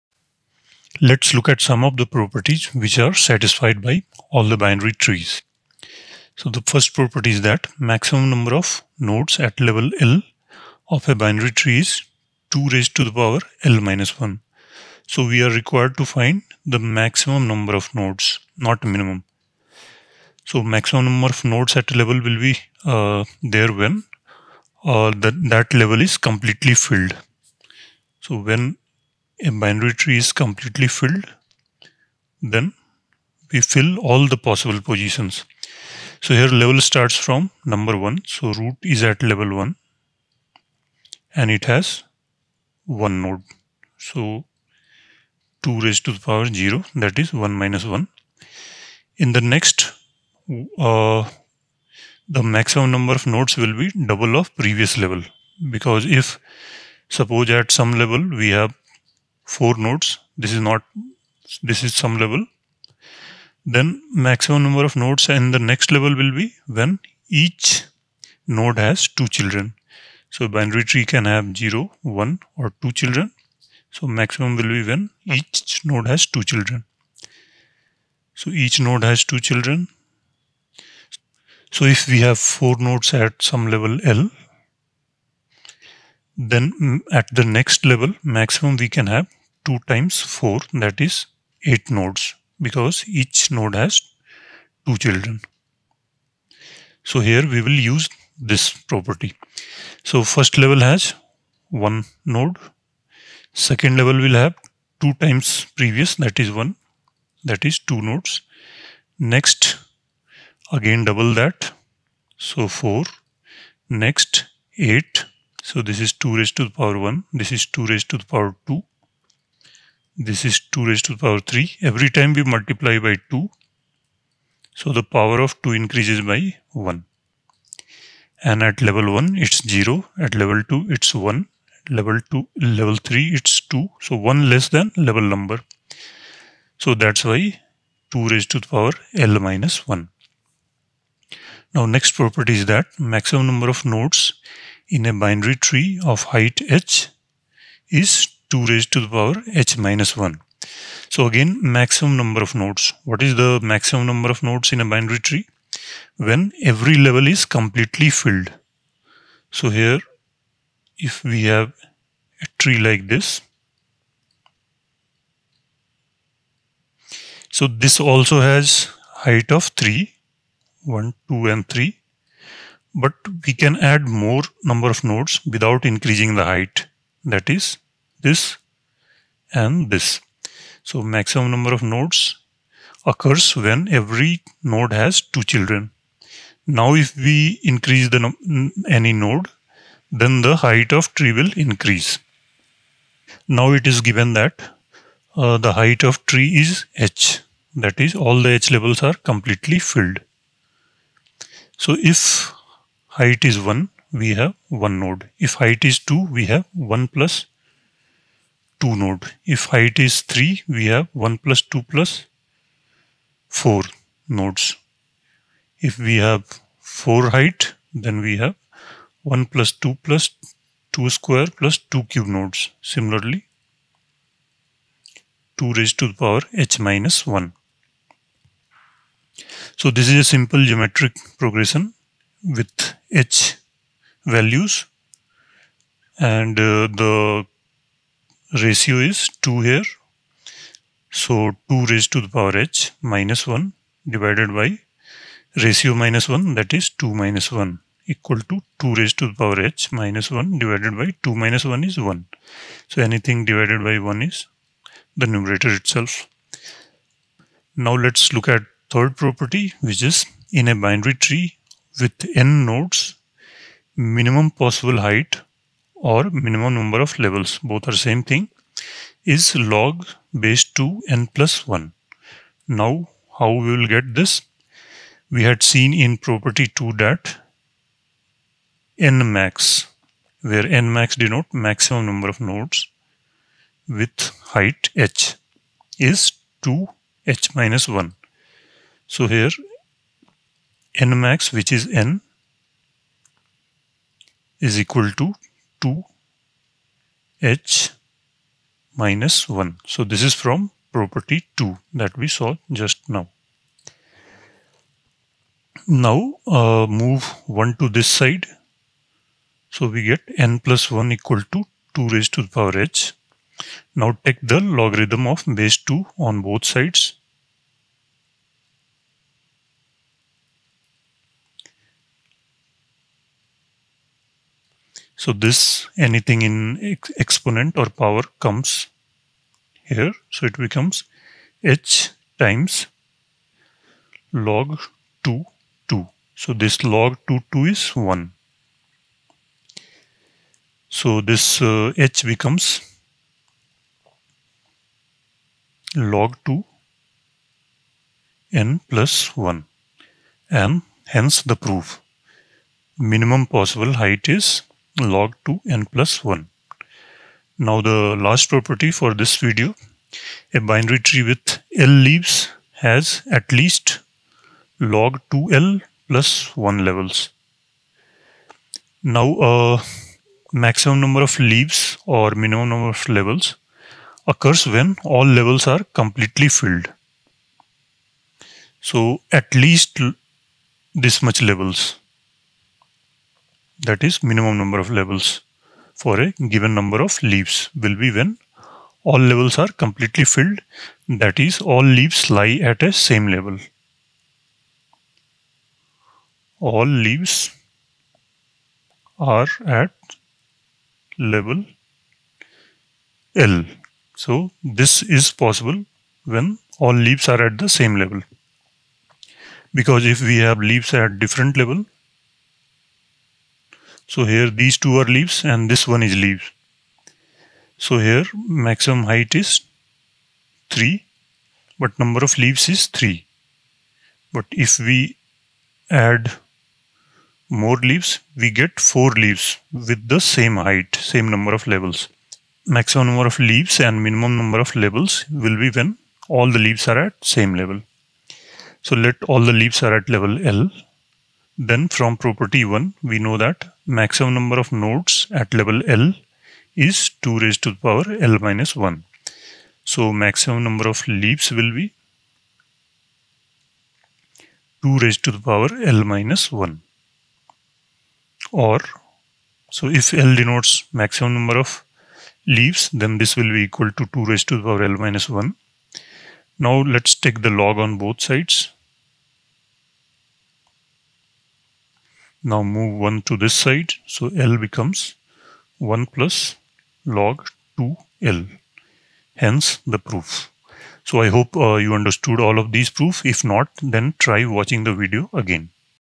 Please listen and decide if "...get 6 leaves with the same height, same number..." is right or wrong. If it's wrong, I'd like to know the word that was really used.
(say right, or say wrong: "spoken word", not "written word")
wrong: "4", not "6".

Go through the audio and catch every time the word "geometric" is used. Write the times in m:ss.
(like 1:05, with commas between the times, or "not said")
3:50.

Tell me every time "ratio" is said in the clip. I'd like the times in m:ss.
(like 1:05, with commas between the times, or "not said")
3:58, 4:05.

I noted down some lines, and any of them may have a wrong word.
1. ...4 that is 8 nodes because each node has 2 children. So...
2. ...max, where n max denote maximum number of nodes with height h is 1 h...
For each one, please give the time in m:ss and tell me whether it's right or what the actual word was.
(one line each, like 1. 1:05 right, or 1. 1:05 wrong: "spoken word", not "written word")
1. 1:30 right
2. 4:39 wrong: "2", not "1".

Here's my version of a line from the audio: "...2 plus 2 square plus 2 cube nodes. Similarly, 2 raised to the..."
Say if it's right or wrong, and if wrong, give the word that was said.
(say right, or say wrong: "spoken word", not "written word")
right.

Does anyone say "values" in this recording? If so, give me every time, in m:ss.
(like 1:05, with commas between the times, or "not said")
3:54.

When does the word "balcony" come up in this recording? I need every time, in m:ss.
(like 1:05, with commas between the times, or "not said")
not said.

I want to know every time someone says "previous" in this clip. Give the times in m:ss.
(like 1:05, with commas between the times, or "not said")
0:54, 1:45.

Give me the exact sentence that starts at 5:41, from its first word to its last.
So this uh, h becomes log 2 n plus 1 and hence the proof minimum possible height is log 2n plus 1.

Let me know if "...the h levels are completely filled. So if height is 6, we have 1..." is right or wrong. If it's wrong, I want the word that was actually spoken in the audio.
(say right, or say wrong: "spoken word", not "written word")
wrong: "1", not "6".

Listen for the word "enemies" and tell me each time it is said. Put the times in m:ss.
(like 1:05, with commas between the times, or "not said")
not said.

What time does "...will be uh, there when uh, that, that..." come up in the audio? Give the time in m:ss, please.
0:22.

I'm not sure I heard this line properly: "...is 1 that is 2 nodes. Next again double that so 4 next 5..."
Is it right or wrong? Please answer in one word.
wrong.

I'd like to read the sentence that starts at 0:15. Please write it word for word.
So we are required to find the maximum number of nodes, not minimum.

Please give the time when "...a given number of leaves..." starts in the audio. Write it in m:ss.
6:26.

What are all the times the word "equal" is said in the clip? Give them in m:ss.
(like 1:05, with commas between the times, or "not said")
4:08, 4:54, 5:11, 7:43.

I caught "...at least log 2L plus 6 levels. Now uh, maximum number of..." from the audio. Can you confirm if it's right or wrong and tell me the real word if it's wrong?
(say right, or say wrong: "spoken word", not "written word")
wrong: "1", not "6".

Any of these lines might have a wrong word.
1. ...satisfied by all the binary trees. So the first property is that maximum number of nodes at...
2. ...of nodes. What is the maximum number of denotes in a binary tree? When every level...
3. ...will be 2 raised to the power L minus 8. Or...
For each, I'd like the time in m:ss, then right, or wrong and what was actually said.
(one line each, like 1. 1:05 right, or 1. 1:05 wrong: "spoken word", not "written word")
1. 0:03 right
2. 2:32 wrong: "nodes", not "denotes"
3. 7:31 wrong: "1", not "8".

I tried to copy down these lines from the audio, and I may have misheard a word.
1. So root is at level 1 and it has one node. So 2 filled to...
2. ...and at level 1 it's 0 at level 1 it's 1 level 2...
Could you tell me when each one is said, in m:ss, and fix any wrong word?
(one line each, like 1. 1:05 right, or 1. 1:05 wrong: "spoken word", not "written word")
1. 0:38 wrong: "raised", not "filled"
2. 2:08 wrong: "2", not "1".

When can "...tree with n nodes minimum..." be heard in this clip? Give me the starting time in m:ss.
4:21.